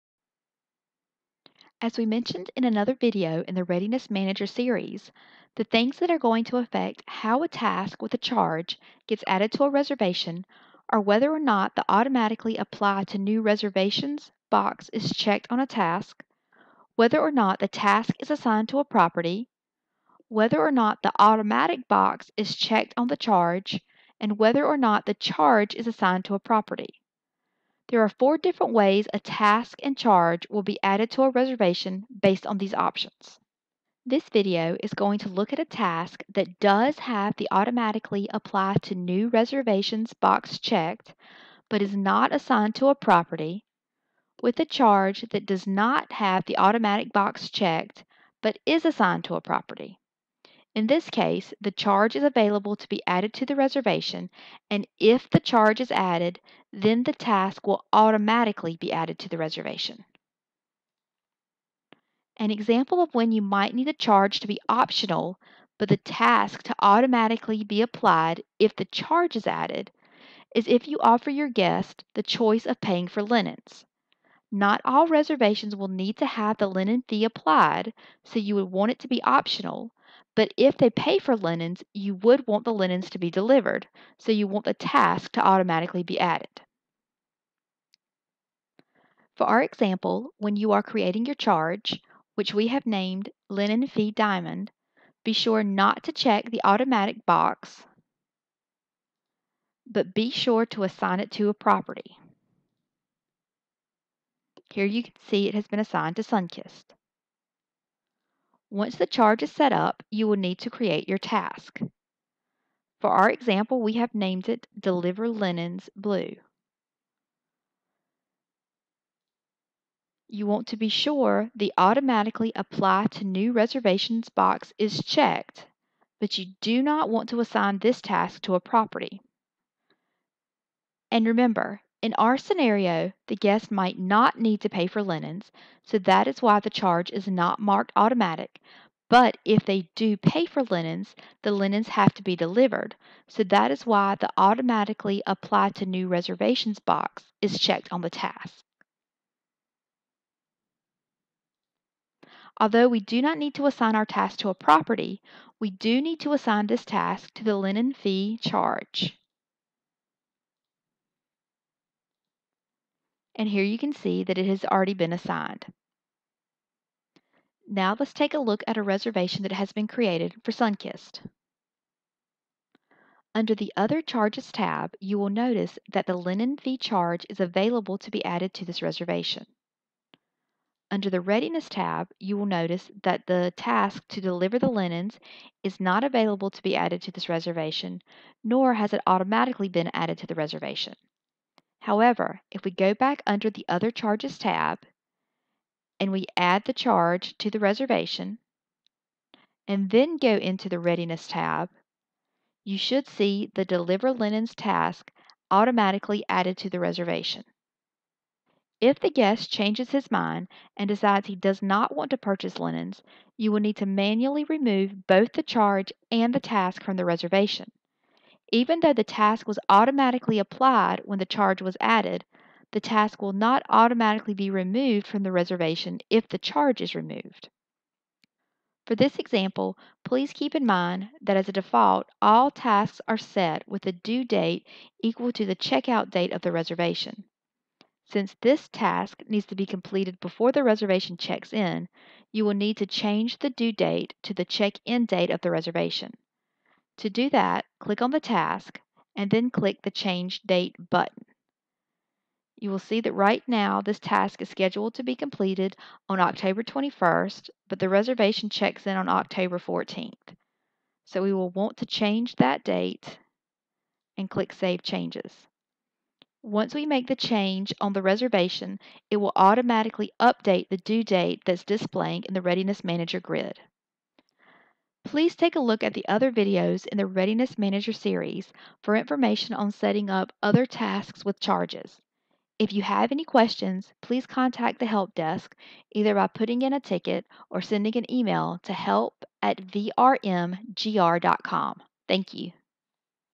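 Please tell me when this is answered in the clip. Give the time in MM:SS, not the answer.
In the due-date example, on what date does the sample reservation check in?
04:19.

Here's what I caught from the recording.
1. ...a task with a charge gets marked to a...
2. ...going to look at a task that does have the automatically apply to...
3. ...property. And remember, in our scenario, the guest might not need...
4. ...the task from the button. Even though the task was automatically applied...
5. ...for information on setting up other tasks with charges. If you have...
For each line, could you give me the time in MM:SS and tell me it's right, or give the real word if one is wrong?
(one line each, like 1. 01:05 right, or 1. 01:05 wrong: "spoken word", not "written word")
1. 00:07 wrong: "added", not "marked"
2. 00:34 right
3. 02:08 right
4. 03:36 wrong: "reservation", not "button"
5. 04:38 right.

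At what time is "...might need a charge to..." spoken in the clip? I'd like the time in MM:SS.
01:03.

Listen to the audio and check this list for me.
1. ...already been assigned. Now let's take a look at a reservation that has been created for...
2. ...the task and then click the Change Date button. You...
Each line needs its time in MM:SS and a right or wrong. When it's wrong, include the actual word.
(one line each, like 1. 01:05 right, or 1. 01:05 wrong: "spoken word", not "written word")
1. 02:44 right
2. 04:08 right.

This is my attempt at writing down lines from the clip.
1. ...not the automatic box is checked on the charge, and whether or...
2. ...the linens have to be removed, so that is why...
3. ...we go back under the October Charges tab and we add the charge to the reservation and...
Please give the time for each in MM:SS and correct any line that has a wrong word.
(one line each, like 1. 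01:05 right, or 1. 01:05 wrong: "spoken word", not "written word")
1. 00:20 right
2. 02:21 wrong: "delivered", not "removed"
3. 03:12 wrong: "Other", not "October".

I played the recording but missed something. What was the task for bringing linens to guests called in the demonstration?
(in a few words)
Deliver Linens Blue.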